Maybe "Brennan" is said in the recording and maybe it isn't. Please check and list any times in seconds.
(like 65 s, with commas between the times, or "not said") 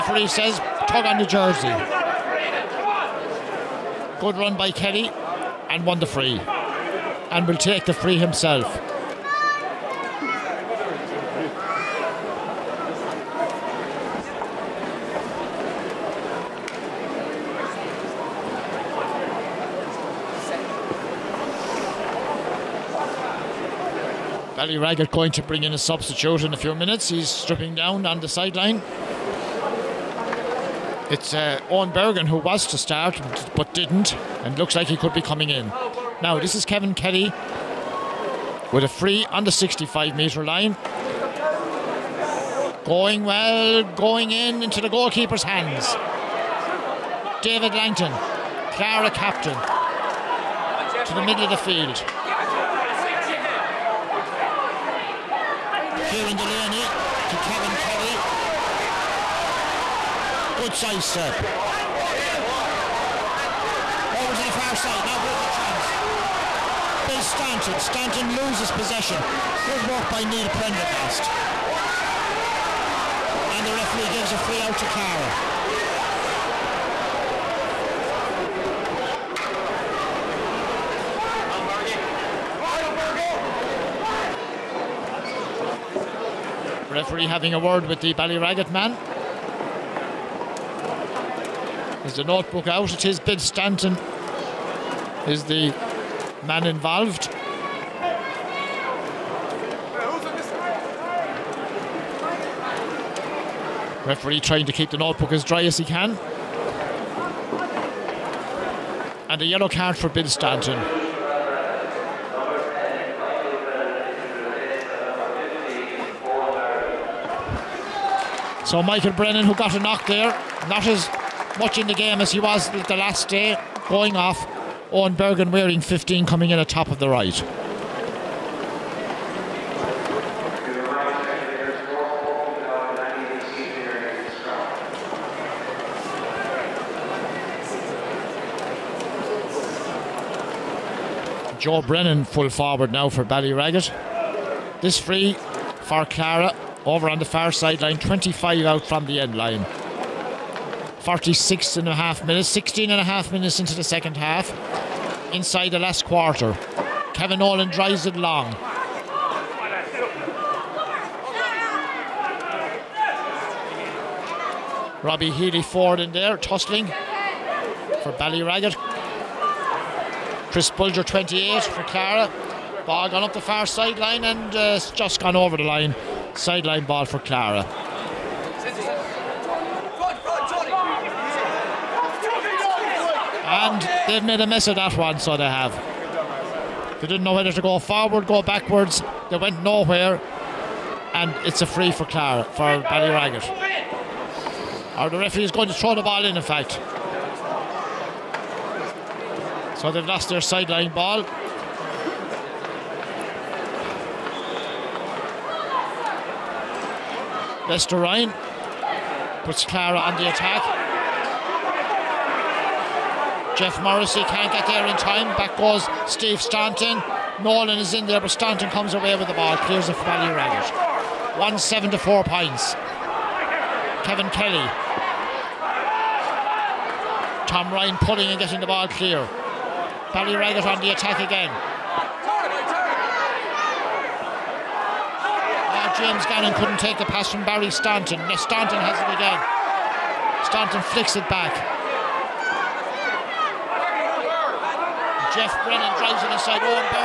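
119 s, 141 s, 245 s.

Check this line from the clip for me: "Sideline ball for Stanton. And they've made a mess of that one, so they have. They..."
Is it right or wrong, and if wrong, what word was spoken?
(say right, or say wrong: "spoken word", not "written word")
wrong: "Clara", not "Stanton".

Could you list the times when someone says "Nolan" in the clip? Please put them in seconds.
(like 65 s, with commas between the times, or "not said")
157 s, 217 s.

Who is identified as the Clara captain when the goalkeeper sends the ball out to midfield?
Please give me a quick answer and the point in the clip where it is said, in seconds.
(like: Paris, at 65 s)
David Langton, at 47 s.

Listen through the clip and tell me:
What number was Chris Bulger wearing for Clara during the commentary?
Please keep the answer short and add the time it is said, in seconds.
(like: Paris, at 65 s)
28, at 171 s.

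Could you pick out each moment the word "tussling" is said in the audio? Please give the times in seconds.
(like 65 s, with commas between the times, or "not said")
166 s.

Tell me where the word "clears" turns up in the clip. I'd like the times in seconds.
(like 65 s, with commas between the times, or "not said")
219 s, 228 s.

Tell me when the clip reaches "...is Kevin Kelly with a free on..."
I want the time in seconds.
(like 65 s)
36 s.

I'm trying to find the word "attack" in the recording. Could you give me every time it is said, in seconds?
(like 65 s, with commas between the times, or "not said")
210 s, 230 s.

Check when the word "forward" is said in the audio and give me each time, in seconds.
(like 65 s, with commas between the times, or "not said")
142 s, 165 s, 187 s.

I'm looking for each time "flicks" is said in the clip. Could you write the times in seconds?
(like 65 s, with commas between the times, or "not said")
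240 s.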